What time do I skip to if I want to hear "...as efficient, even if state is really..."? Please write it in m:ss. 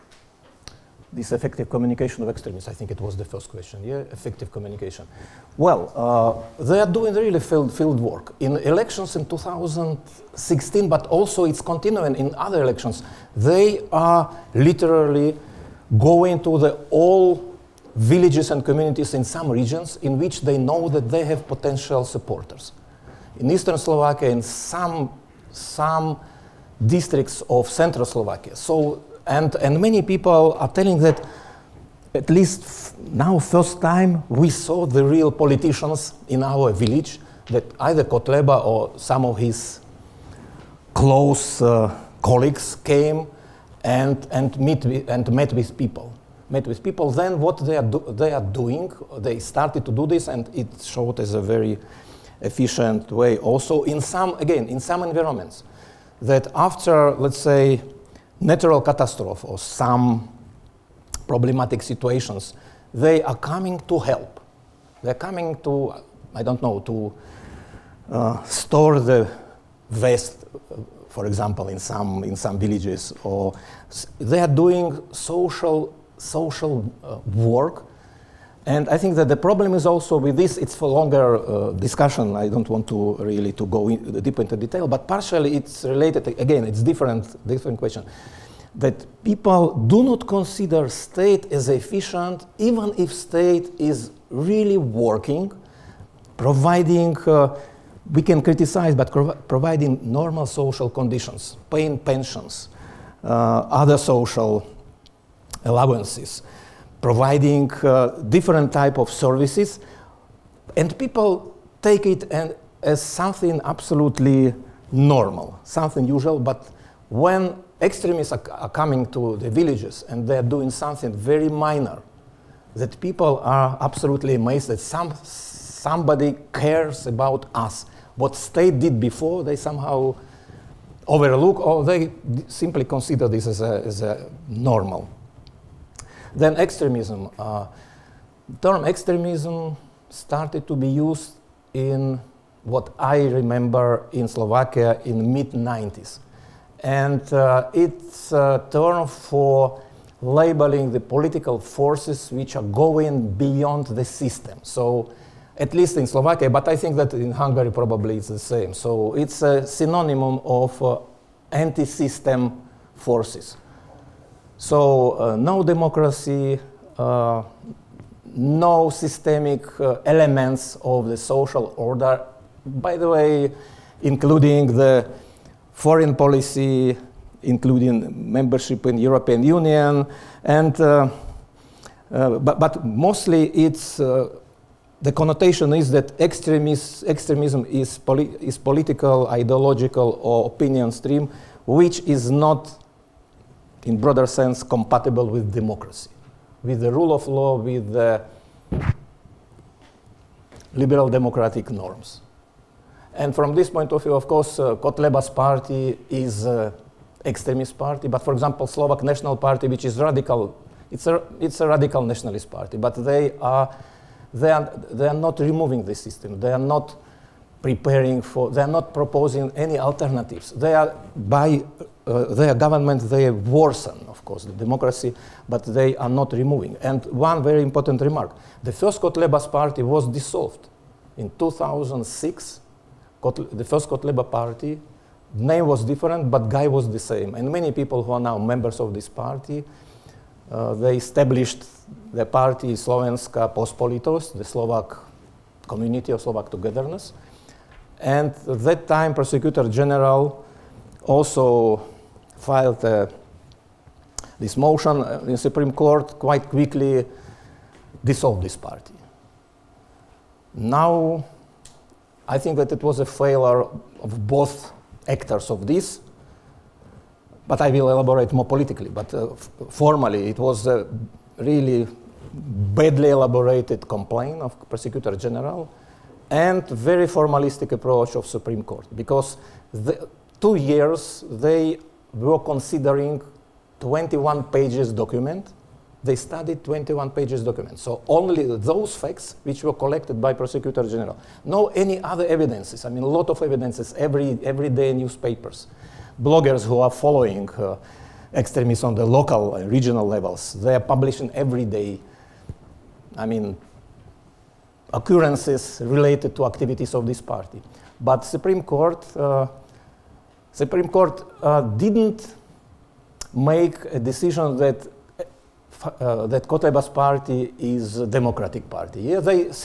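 1:31.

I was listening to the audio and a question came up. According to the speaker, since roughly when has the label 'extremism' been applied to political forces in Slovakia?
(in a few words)
mid 90s.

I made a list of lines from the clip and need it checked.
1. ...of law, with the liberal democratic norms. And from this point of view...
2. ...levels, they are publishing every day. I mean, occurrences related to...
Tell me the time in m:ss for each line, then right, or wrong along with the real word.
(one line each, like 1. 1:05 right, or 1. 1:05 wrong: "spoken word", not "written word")
1. 3:17 right
2. 5:00 right.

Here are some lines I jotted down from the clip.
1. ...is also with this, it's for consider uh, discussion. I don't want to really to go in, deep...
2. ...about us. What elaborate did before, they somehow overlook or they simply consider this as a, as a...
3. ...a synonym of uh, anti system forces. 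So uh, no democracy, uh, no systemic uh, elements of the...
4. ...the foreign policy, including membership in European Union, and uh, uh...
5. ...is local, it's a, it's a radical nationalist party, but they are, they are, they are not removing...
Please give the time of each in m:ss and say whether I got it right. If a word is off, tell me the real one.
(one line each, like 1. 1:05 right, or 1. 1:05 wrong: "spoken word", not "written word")
1. 1:19 wrong: "longer", not "consider"
2. 2:07 wrong: "state", not "elaborate"
3. 2:39 right
4. 2:54 right
5. 3:29 wrong: "radical", not "local".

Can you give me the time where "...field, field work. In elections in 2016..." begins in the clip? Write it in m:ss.
0:07.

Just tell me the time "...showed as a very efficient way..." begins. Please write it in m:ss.
0:50.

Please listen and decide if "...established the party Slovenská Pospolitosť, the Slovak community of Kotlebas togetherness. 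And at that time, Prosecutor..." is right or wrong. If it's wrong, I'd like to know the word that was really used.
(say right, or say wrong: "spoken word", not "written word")
wrong: "Slovak", not "Kotlebas".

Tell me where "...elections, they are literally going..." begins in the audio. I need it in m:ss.
0:12.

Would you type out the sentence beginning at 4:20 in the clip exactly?
Now, I think that it was a failure of both actors of this, but I will elaborate more politically.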